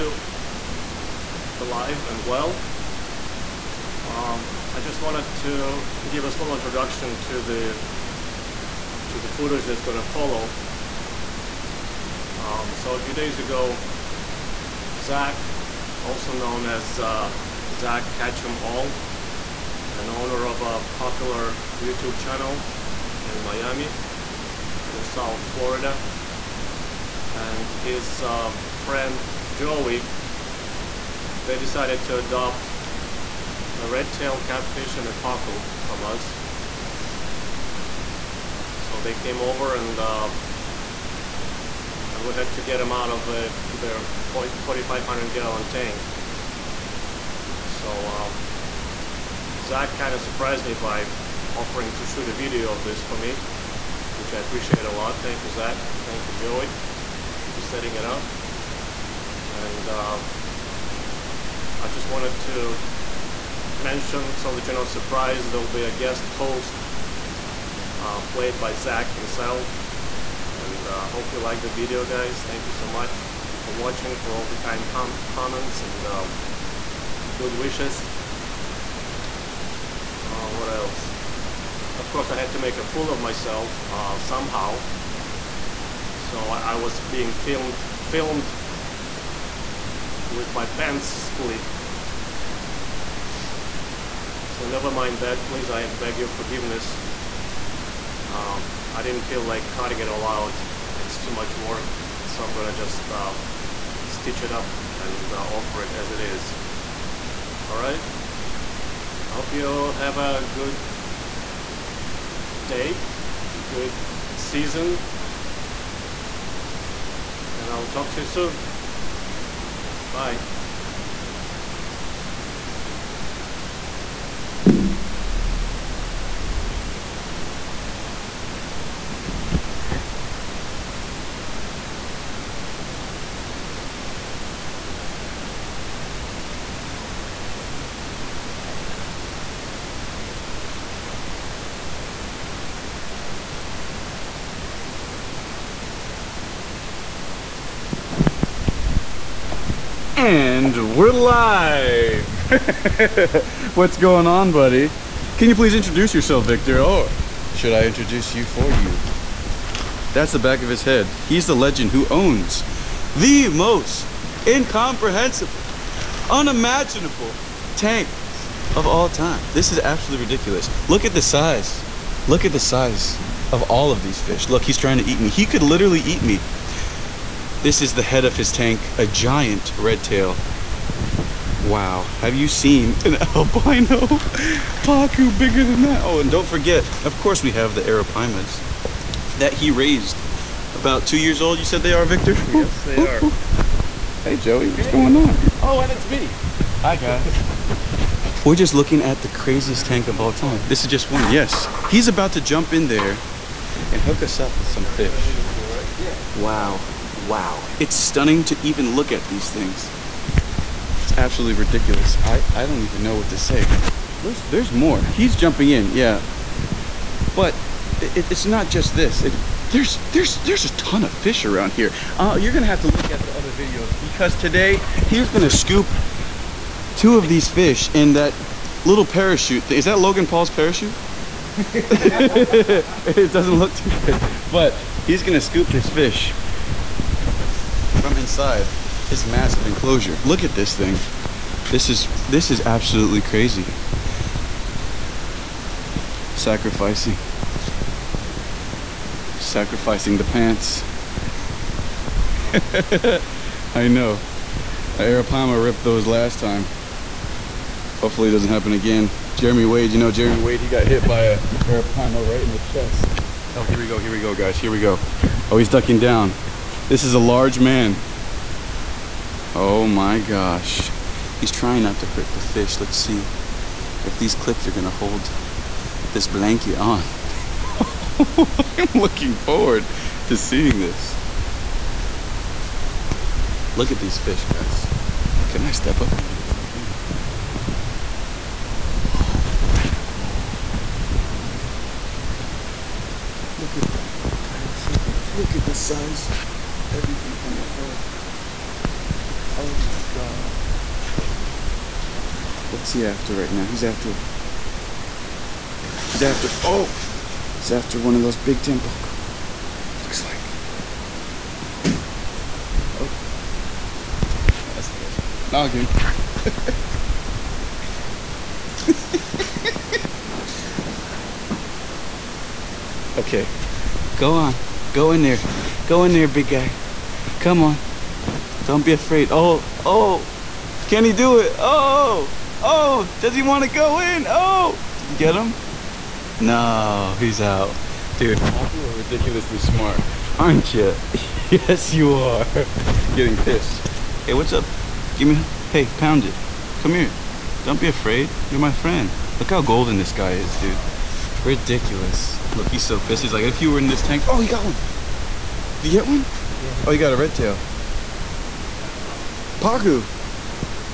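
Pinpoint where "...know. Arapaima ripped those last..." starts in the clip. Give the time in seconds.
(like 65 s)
253 s.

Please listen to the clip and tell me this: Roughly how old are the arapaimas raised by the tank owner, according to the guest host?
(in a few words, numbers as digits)
2 years.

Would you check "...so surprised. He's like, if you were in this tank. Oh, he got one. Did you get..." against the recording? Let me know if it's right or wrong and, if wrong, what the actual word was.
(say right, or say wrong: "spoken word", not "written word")
wrong: "pissed", not "surprised".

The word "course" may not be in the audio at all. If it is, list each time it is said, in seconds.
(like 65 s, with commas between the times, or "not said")
82 s, 187 s.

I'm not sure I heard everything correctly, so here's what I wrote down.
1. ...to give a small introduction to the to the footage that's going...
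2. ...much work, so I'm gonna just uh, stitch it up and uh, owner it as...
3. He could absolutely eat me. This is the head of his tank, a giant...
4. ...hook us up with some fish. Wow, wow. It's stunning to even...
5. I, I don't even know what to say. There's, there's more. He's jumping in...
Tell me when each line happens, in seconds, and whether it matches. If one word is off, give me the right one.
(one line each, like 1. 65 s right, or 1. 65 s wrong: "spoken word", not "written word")
1. 5 s right
2. 101 s wrong: "offer", not "owner"
3. 175 s wrong: "literally", not "absolutely"
4. 203 s right
5. 212 s right.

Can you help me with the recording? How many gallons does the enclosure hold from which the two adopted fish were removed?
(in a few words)
4,500 gallons.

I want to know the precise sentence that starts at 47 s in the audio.
So uh, Zak kind of surprised me by offering to shoot a video of this for me which I appreciate a lot.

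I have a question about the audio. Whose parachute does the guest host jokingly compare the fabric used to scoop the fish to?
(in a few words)
Logan Paul.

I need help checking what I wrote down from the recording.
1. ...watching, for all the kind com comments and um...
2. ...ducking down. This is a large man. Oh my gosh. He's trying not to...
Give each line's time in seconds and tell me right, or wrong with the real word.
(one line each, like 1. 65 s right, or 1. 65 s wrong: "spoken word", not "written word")
1. 73 s right
2. 265 s right.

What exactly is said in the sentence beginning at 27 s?
And his uh, friend Joey, they decided to adopt a red-tailed catfish and a pacu from us.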